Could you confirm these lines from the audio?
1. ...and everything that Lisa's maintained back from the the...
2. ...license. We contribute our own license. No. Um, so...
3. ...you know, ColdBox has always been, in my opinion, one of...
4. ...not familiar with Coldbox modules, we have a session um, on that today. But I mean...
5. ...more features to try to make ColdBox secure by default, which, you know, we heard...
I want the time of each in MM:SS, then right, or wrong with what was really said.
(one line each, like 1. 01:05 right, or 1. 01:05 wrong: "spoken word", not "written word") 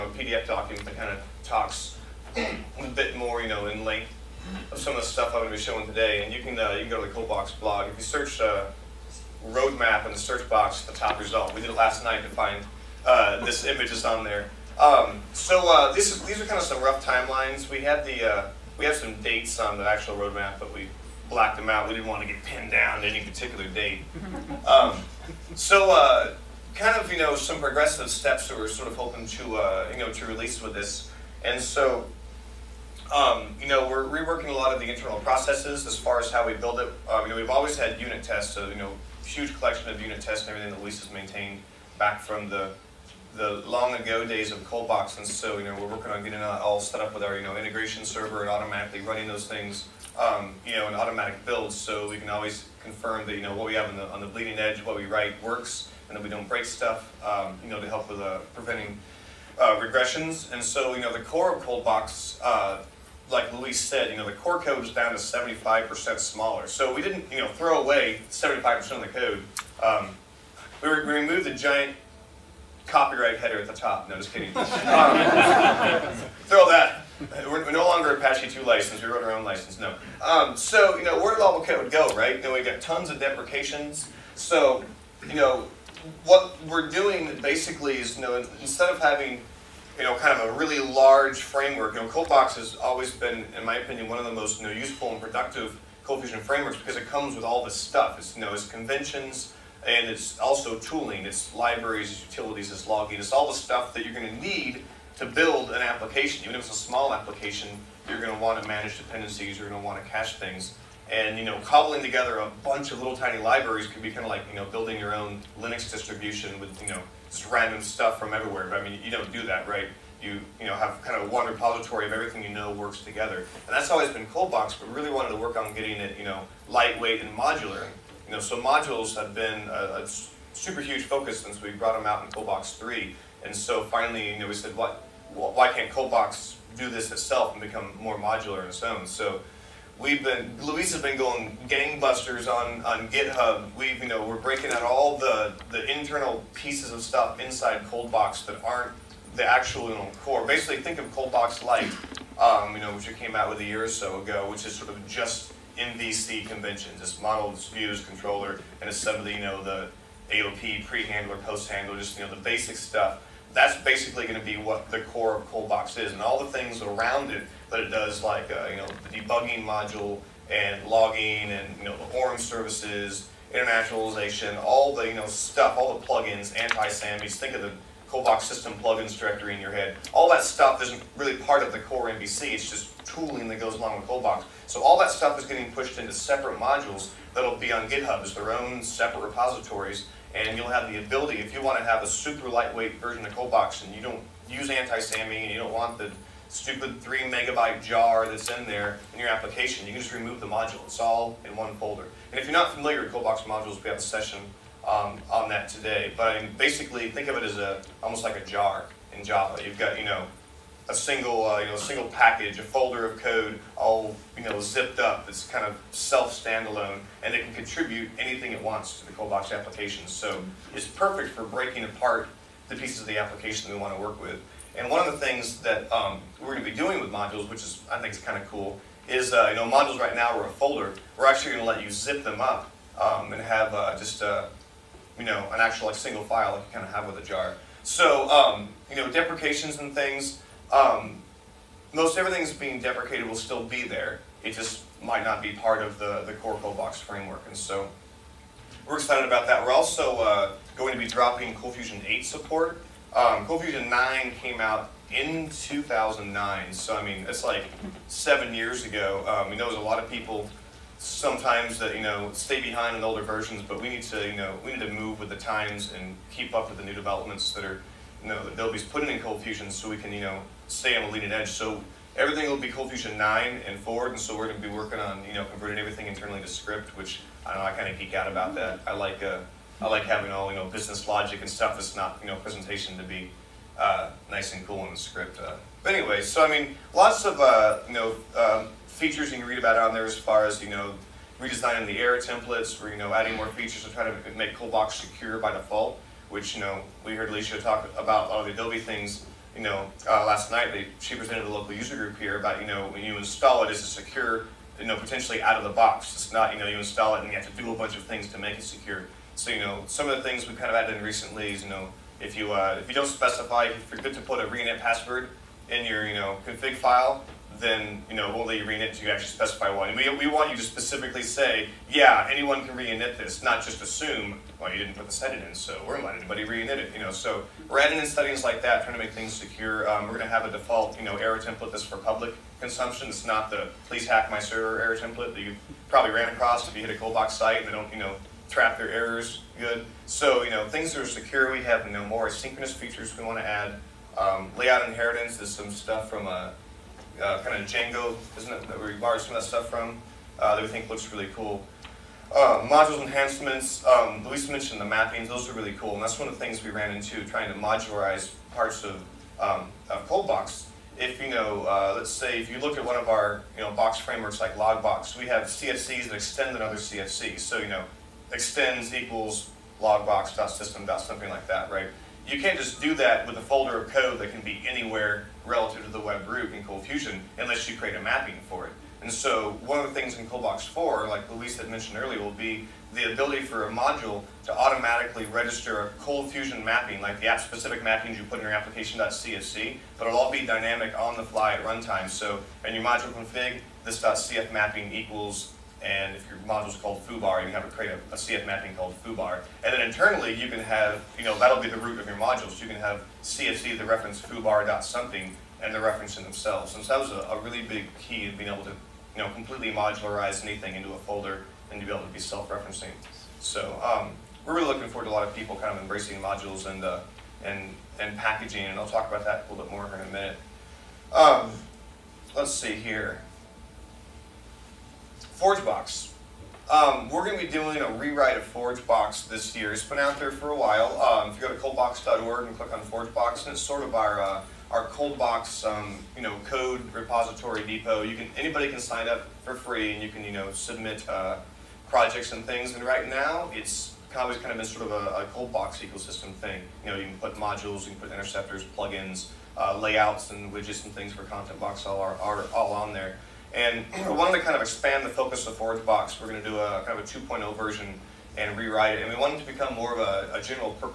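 1. 00:40 right
2. 01:18 wrong: "wrote", not "contribute"
3. 01:31 right
4. 03:22 right
5. 04:53 right.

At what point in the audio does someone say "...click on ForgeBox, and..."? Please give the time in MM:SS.
07:12.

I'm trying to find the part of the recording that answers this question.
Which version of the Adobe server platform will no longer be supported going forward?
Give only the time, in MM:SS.
04:11.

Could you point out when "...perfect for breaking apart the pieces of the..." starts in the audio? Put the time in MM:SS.
03:40.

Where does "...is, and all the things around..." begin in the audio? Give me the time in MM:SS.
02:45.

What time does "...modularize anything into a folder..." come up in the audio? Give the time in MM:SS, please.
06:49.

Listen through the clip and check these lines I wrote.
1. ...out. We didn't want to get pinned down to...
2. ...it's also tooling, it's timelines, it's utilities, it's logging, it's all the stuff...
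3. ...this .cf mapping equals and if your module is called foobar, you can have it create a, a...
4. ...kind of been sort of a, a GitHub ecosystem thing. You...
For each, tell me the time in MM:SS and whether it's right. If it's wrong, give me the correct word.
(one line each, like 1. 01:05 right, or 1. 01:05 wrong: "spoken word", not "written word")
1. 00:21 right
2. 01:40 wrong: "libraries", not "timelines"
3. 06:33 right
4. 07:24 wrong: "ColdBox", not "GitHub".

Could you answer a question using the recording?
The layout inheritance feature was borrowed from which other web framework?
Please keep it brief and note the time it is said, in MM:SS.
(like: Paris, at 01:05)
Django, at 05:47.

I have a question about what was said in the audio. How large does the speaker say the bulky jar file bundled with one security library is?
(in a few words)
3 megabytes.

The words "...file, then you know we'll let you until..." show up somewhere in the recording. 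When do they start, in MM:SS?
05:16.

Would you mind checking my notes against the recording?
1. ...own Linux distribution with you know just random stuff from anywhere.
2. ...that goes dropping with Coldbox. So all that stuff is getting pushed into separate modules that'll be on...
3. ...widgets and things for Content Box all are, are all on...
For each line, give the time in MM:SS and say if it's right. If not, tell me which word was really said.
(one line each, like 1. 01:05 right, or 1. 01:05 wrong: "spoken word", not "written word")
1. 01:55 wrong: "everywhere", not "anywhere"
2. 03:03 wrong: "along", not "dropping"
3. 07:30 right.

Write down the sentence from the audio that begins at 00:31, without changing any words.
And so, um, you know, we're reworking a lot of the internal processes as far as how we build it.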